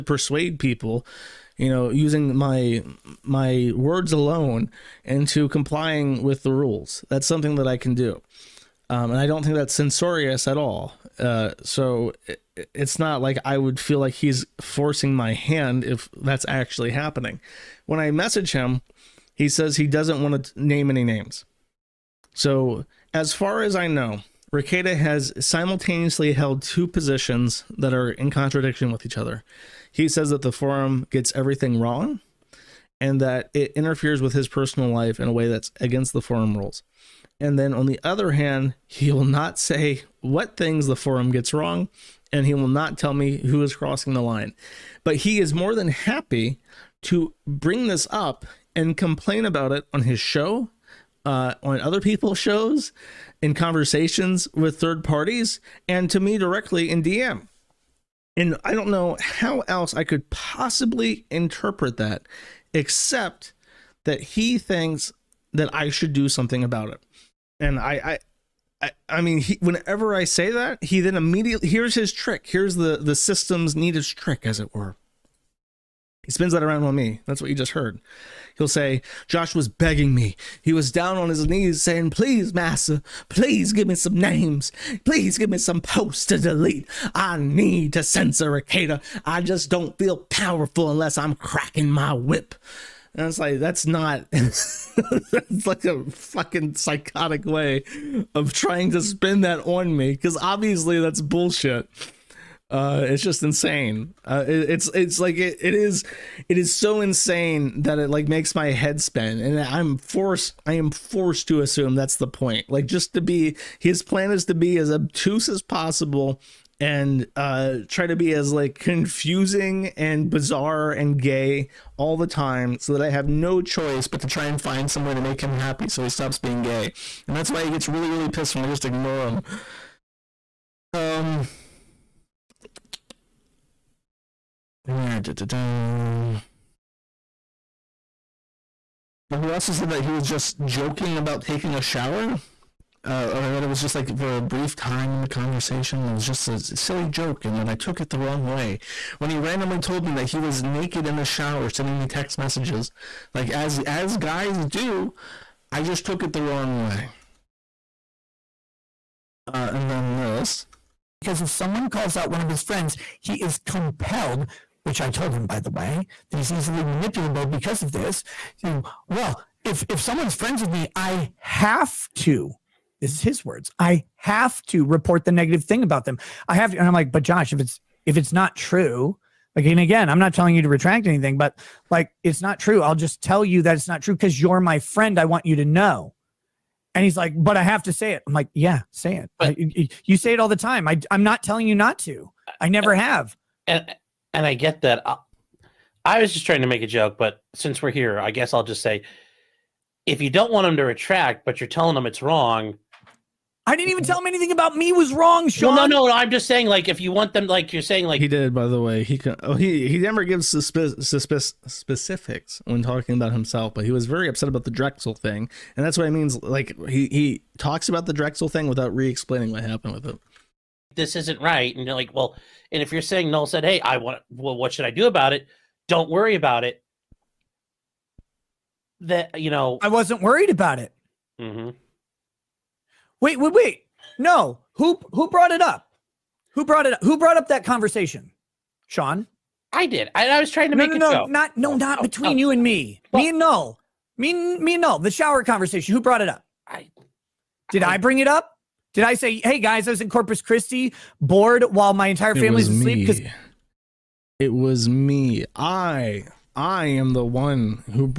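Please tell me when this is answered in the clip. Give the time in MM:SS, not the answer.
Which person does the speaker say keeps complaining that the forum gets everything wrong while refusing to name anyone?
00:24.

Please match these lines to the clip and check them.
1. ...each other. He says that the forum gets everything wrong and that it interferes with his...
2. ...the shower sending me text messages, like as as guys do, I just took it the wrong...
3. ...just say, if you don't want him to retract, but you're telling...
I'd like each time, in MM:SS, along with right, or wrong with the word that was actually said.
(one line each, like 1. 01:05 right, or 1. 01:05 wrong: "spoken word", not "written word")
1. 00:29 right
2. 02:31 right
3. 03:18 right.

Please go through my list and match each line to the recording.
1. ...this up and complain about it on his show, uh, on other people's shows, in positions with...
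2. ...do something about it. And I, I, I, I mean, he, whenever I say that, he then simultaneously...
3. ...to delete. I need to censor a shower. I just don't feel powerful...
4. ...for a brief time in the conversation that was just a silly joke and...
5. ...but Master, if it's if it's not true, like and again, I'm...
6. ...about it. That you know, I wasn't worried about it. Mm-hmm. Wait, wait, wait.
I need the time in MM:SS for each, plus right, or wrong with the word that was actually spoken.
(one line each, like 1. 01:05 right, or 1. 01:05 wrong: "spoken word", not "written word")
1. 00:47 wrong: "conversations", not "positions"
2. 01:06 wrong: "immediately", not "simultaneously"
3. 01:26 wrong: "cater", not "shower"
4. 02:24 right
5. 02:57 wrong: "Josh", not "Master"
6. 03:46 right.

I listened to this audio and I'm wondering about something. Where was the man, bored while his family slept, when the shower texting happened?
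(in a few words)
Corpus Christi.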